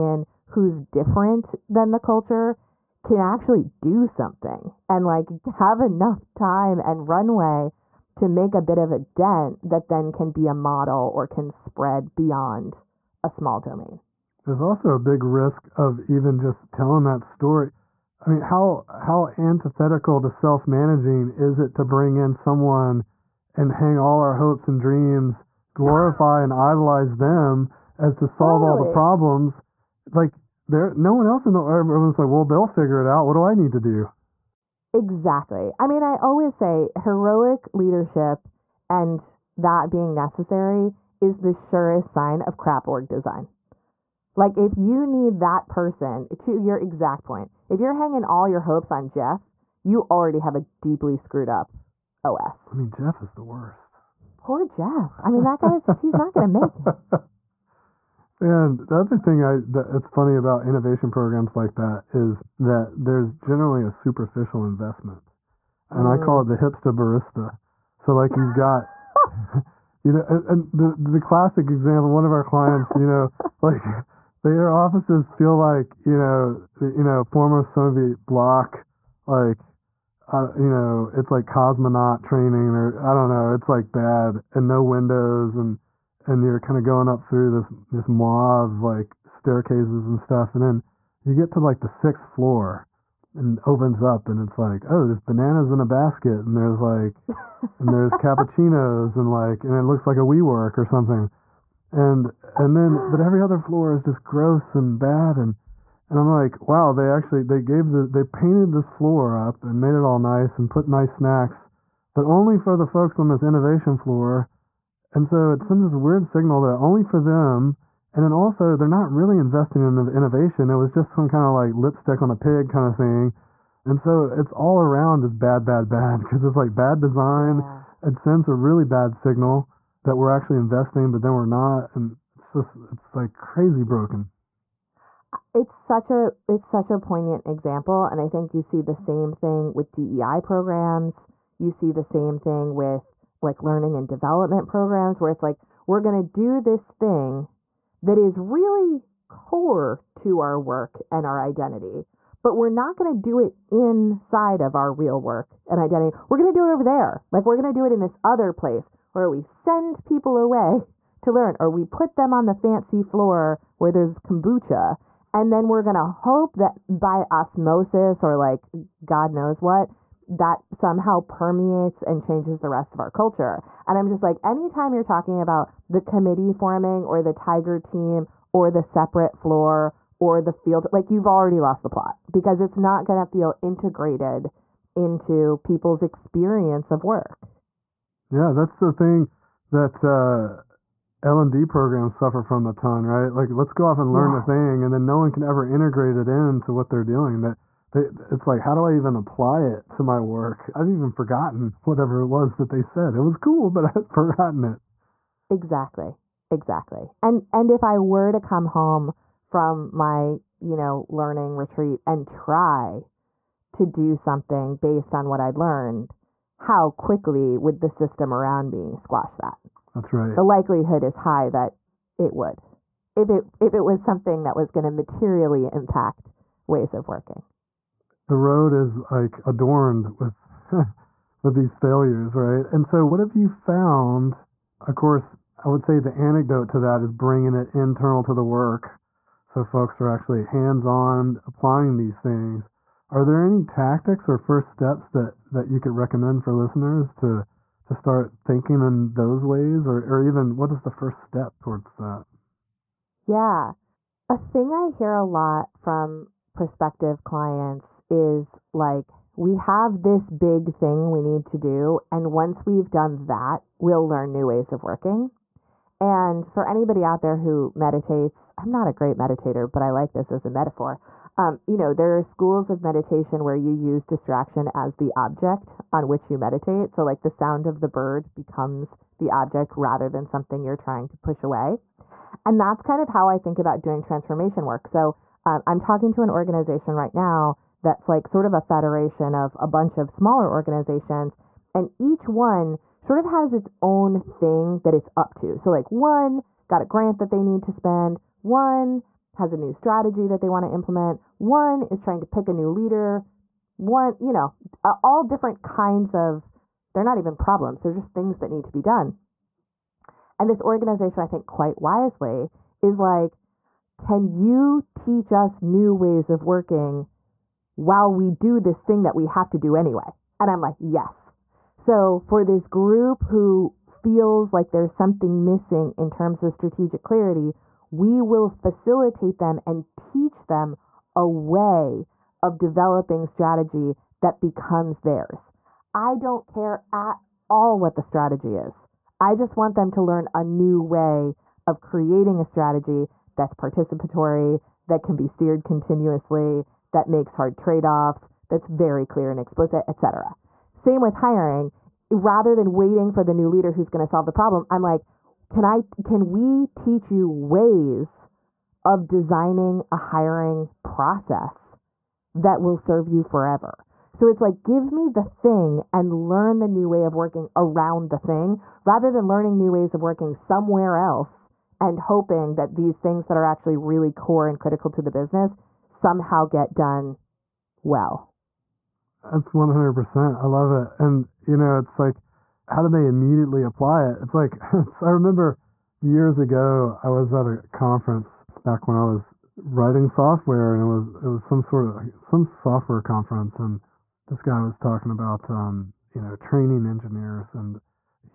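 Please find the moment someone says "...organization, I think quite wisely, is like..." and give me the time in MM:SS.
05:10.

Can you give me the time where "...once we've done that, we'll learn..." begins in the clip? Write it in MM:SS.
04:22.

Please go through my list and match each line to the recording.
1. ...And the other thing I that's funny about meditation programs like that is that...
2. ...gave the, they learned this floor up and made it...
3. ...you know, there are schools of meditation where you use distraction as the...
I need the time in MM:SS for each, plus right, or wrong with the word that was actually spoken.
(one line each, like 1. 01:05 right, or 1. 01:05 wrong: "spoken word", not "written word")
1. 00:58 wrong: "innovation", not "meditation"
2. 01:47 wrong: "painted", not "learned"
3. 04:31 right.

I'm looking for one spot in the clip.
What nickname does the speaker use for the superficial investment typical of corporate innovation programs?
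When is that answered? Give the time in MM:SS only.
01:06.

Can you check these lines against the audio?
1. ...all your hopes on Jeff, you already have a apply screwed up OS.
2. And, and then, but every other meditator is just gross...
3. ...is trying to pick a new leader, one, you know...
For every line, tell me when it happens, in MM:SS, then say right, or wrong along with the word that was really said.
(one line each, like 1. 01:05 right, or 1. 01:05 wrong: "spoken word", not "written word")
1. 00:48 wrong: "deeply", not "apply"
2. 01:41 wrong: "floor", not "meditator"
3. 05:01 right.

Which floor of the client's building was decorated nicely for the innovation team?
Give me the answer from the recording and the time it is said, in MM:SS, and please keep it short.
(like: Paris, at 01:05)
sixth floor, at 01:31.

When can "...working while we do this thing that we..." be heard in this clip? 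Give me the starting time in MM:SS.
05:16.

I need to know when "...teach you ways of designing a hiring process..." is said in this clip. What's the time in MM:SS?
05:56.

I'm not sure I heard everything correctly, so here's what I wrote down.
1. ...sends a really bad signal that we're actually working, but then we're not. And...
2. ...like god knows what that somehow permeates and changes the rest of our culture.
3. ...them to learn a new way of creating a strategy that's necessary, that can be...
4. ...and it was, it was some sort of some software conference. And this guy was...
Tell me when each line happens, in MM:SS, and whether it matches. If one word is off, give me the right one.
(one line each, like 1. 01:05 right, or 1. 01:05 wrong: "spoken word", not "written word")
1. 02:08 wrong: "investing", not "working"
2. 02:48 right
3. 05:39 wrong: "participatory", not "necessary"
4. 06:30 right.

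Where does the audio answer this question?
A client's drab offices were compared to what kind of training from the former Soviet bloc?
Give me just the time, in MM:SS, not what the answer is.
01:21.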